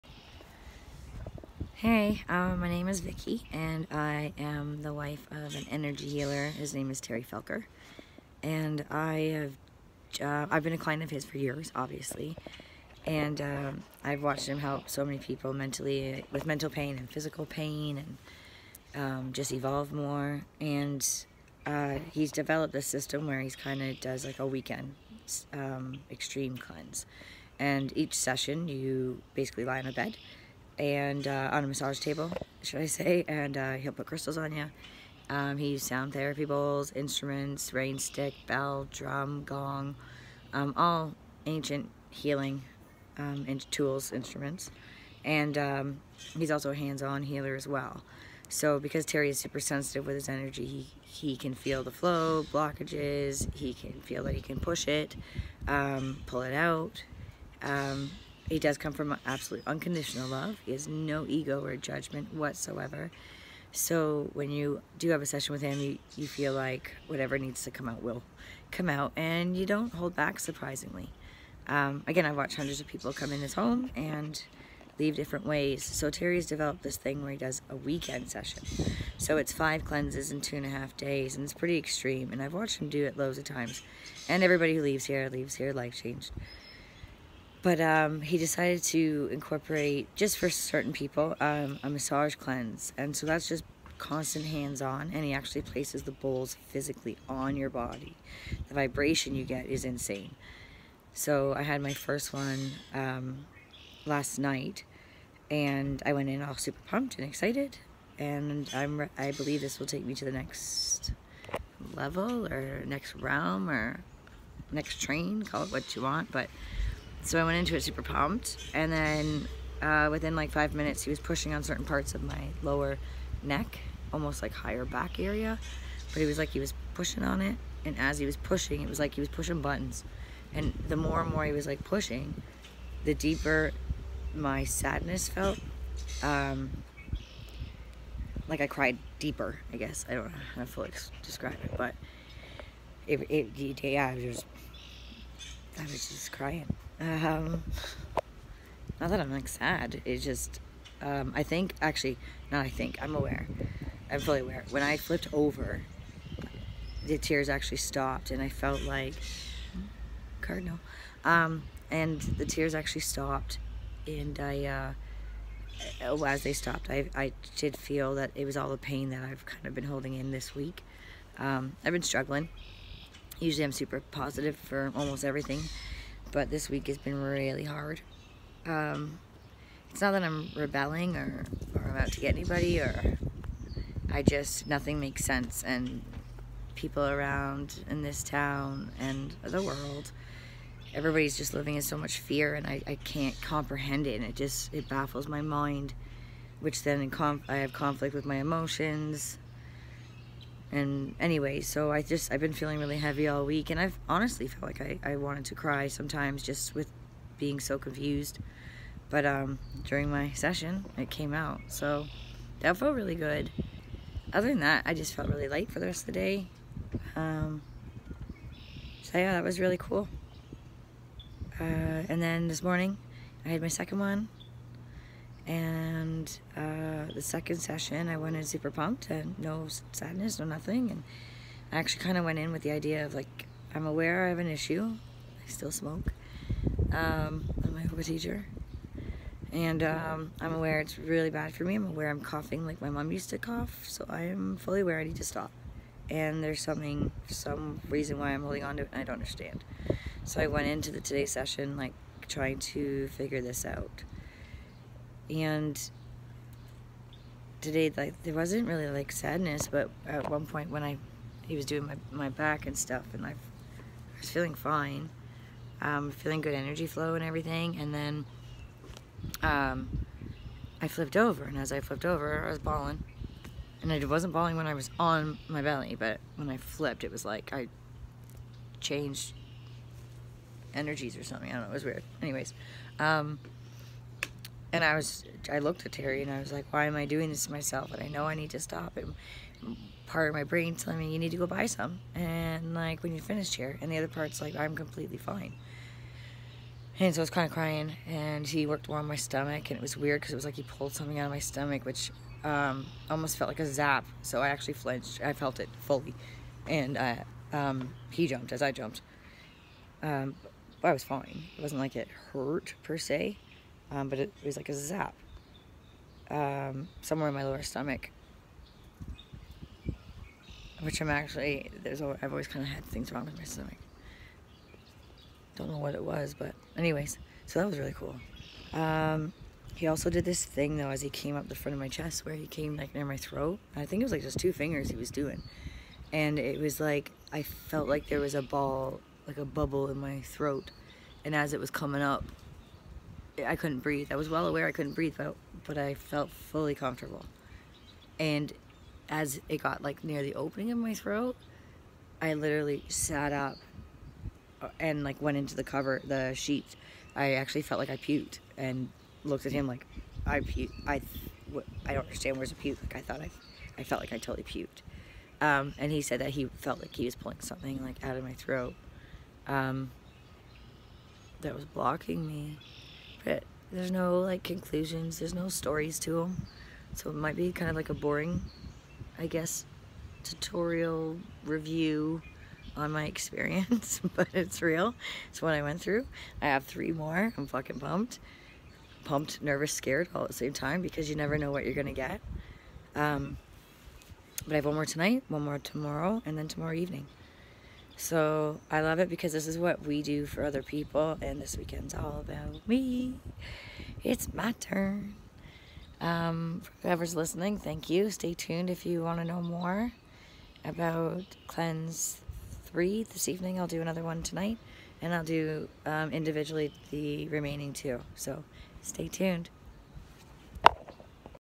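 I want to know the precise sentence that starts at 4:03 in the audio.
So I am fully aware I need to stop.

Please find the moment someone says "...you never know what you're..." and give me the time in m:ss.
6:31.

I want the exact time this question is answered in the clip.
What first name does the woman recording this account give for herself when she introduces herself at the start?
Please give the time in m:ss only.
0:02.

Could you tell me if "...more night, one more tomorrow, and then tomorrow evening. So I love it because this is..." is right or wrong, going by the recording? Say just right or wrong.
wrong.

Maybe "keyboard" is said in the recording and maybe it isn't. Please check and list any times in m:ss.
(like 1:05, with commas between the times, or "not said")
not said.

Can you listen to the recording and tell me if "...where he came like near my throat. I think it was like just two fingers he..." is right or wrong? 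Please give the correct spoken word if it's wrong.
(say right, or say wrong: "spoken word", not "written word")
right.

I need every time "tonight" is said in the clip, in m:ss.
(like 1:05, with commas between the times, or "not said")
6:34, 6:54.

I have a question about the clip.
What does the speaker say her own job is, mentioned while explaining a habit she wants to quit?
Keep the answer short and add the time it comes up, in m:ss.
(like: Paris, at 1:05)
Yoga teacher, at 3:57.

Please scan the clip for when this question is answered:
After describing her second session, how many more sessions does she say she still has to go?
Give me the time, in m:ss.
6:26.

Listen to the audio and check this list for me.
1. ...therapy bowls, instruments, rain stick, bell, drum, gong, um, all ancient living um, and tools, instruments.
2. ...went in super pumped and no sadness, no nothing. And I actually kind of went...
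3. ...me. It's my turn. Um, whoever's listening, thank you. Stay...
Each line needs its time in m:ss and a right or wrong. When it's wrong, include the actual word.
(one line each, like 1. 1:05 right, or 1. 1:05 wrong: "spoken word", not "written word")
1. 0:36 wrong: "healing", not "living"
2. 3:48 right
3. 6:42 right.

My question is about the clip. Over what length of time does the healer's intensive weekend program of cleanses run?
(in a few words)
2 and a half days.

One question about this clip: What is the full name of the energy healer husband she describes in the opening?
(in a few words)
Terry Felker.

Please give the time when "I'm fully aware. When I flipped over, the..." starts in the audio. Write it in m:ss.
2:34.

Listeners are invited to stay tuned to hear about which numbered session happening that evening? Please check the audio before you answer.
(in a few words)
Cleanse 3.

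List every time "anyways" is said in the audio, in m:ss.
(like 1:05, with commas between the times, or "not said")
3:21, 4:42, 5:26.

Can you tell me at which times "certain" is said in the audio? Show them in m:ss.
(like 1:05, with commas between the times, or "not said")
1:30, 2:01.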